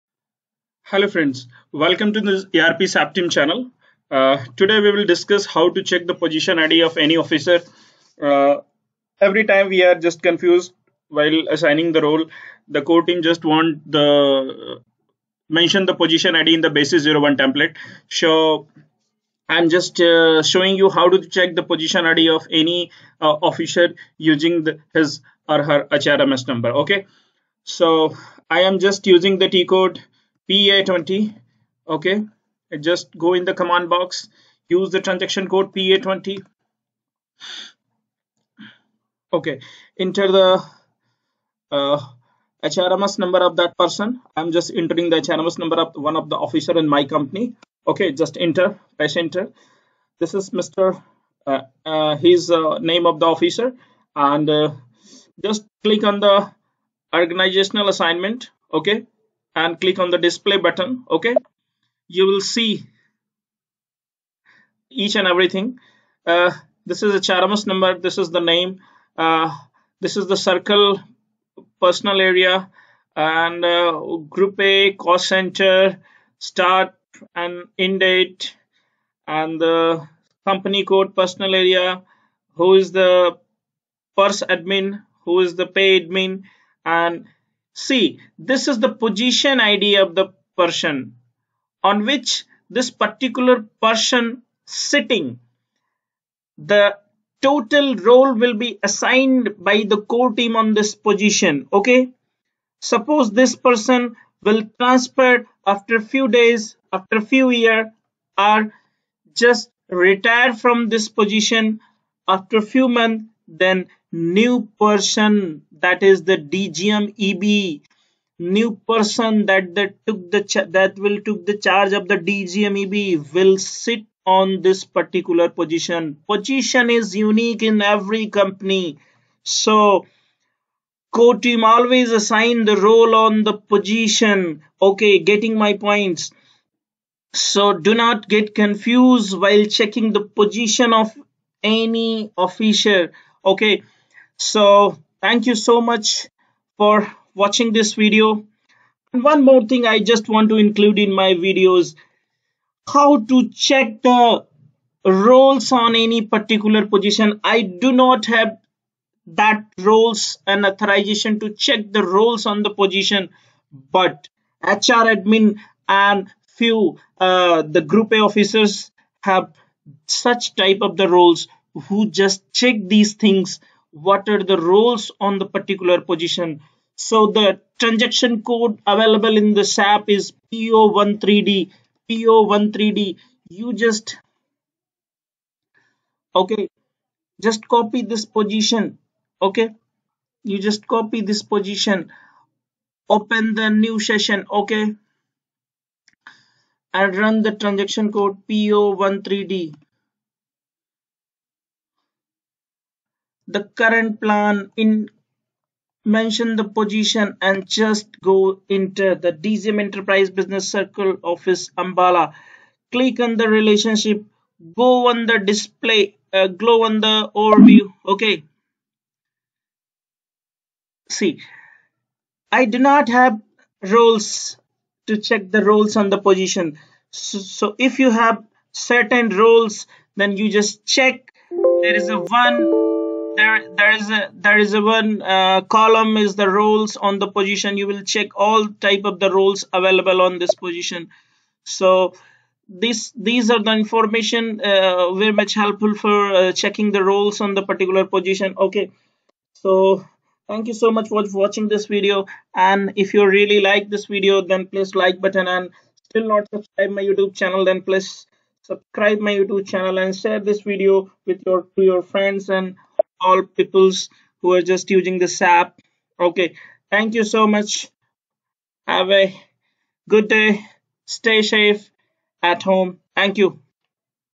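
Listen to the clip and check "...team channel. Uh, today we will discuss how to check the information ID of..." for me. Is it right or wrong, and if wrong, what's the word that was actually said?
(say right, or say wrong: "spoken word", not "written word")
wrong: "position", not "information".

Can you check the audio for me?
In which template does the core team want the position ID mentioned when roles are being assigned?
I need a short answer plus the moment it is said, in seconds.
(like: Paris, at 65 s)
basis 01, at 16 s.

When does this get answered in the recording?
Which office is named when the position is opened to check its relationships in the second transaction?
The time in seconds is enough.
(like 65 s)
210 s.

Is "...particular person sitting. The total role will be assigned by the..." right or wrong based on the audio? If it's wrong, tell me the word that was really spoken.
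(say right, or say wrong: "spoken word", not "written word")
right.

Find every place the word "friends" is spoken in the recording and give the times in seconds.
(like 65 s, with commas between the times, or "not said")
1 s, 262 s.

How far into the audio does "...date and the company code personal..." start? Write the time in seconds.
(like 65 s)
77 s.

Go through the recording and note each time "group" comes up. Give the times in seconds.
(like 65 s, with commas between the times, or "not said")
74 s, 167 s.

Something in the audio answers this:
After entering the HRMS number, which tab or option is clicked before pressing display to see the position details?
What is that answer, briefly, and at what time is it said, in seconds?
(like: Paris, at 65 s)
organizational assignment, at 57 s.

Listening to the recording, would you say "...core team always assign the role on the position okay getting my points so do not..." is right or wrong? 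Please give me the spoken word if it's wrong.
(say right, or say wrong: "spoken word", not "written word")
right.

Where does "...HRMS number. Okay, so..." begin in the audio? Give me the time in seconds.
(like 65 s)
25 s.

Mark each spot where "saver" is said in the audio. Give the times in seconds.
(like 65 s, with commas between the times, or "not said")
not said.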